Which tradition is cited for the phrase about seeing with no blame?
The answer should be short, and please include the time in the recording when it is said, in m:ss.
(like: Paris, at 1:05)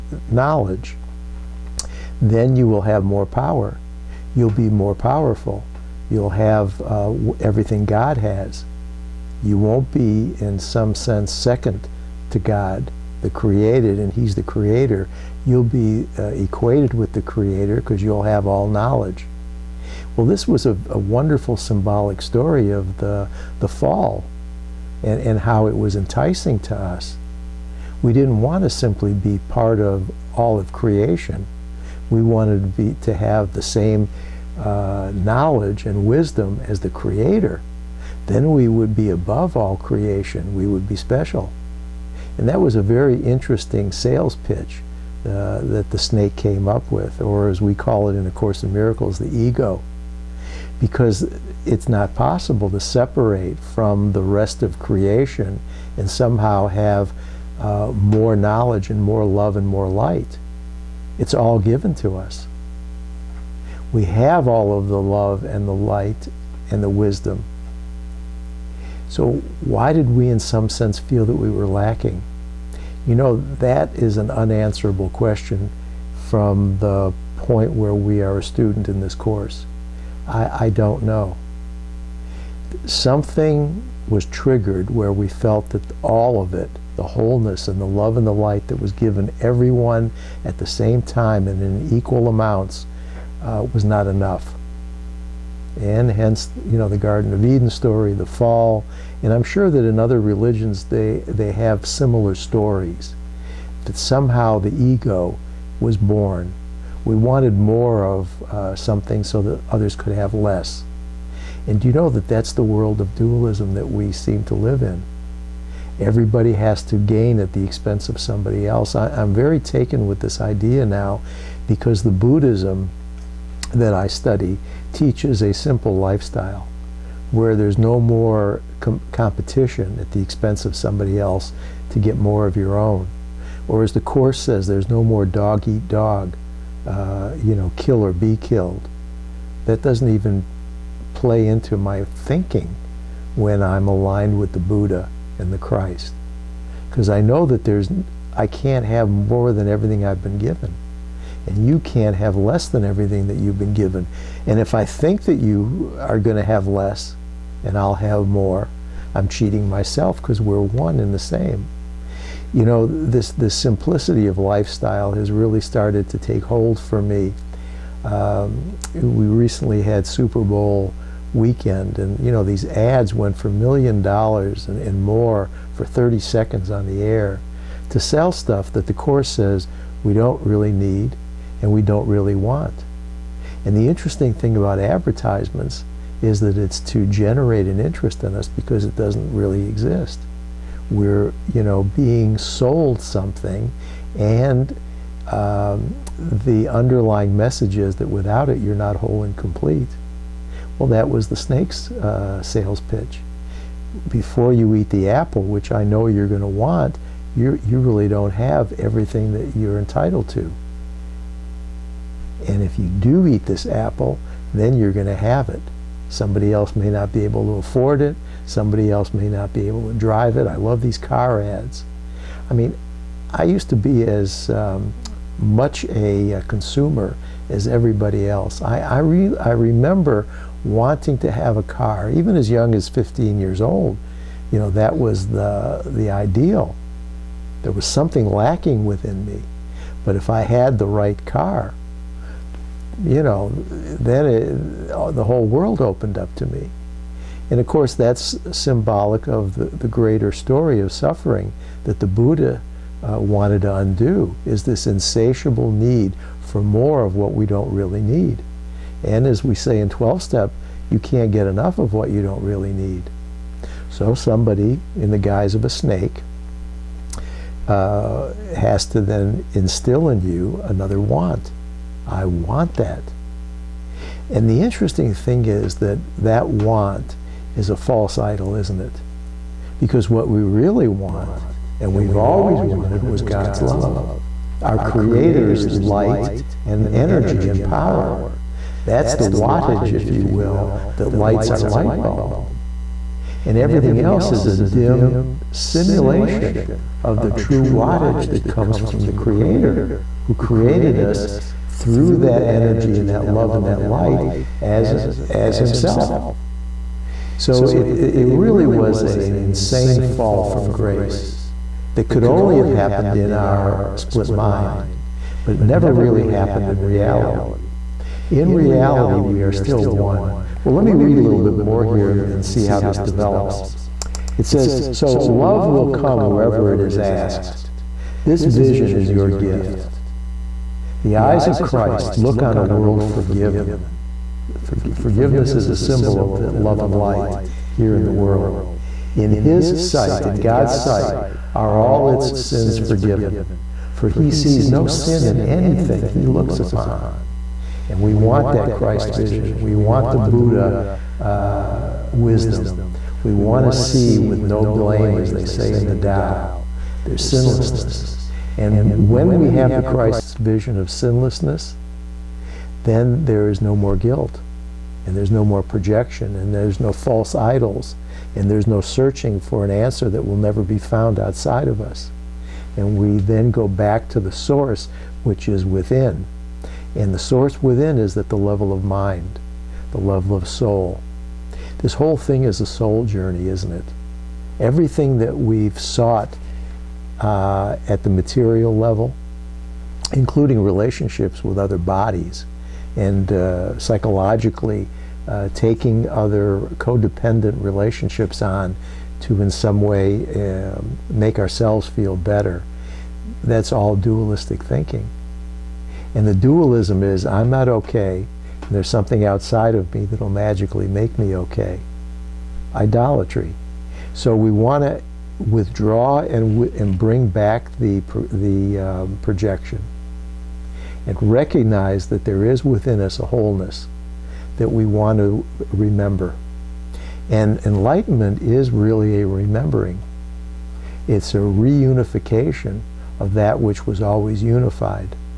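the Tao, at 5:55.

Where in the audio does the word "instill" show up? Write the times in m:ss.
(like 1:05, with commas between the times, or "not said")
4:29.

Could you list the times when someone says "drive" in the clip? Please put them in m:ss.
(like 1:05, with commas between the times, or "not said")
3:39.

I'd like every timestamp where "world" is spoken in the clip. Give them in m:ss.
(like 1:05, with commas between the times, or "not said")
1:52, 4:05, 5:32, 5:38.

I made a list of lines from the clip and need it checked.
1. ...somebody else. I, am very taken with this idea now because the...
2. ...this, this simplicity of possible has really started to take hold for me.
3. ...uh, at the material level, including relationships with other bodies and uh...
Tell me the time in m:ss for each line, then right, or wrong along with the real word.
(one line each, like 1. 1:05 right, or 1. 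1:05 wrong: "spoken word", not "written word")
1. 1:58 right
2. 2:42 wrong: "lifestyle", not "possible"
3. 6:27 right.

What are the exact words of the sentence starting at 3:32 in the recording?
And if you do eat this apple, then you're going to have it.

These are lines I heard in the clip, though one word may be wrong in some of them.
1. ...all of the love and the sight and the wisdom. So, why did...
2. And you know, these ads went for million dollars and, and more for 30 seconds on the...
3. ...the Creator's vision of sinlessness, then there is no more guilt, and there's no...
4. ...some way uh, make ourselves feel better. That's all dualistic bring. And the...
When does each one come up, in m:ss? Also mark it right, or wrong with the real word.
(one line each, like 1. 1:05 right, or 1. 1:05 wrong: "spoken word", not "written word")
1. 1:04 wrong: "light", not "sight"
2. 2:51 right
3. 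5:59 wrong: "Christ", not "Creator"
4. 6:39 wrong: "thinking", not "bring".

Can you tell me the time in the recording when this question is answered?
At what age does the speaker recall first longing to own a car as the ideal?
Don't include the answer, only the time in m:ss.
3:52.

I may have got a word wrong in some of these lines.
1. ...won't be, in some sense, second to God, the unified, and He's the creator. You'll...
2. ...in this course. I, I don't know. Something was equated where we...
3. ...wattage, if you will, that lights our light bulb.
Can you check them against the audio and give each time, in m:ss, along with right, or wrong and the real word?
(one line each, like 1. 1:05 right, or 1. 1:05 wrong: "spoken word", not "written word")
1. 0:09 wrong: "created", not "unified"
2. 1:18 wrong: "triggered", not "equated"
3. 4:49 right.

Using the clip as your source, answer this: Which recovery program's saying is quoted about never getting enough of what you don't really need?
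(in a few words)
12 step.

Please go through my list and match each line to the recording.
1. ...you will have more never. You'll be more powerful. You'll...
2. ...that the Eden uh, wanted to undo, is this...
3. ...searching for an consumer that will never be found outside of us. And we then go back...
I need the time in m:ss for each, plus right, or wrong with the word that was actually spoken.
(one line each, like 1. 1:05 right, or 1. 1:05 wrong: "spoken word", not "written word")
1. 0:02 wrong: "power", not "never"
2. 4:11 wrong: "Buddha", not "Eden"
3. 6:08 wrong: "answer", not "consumer".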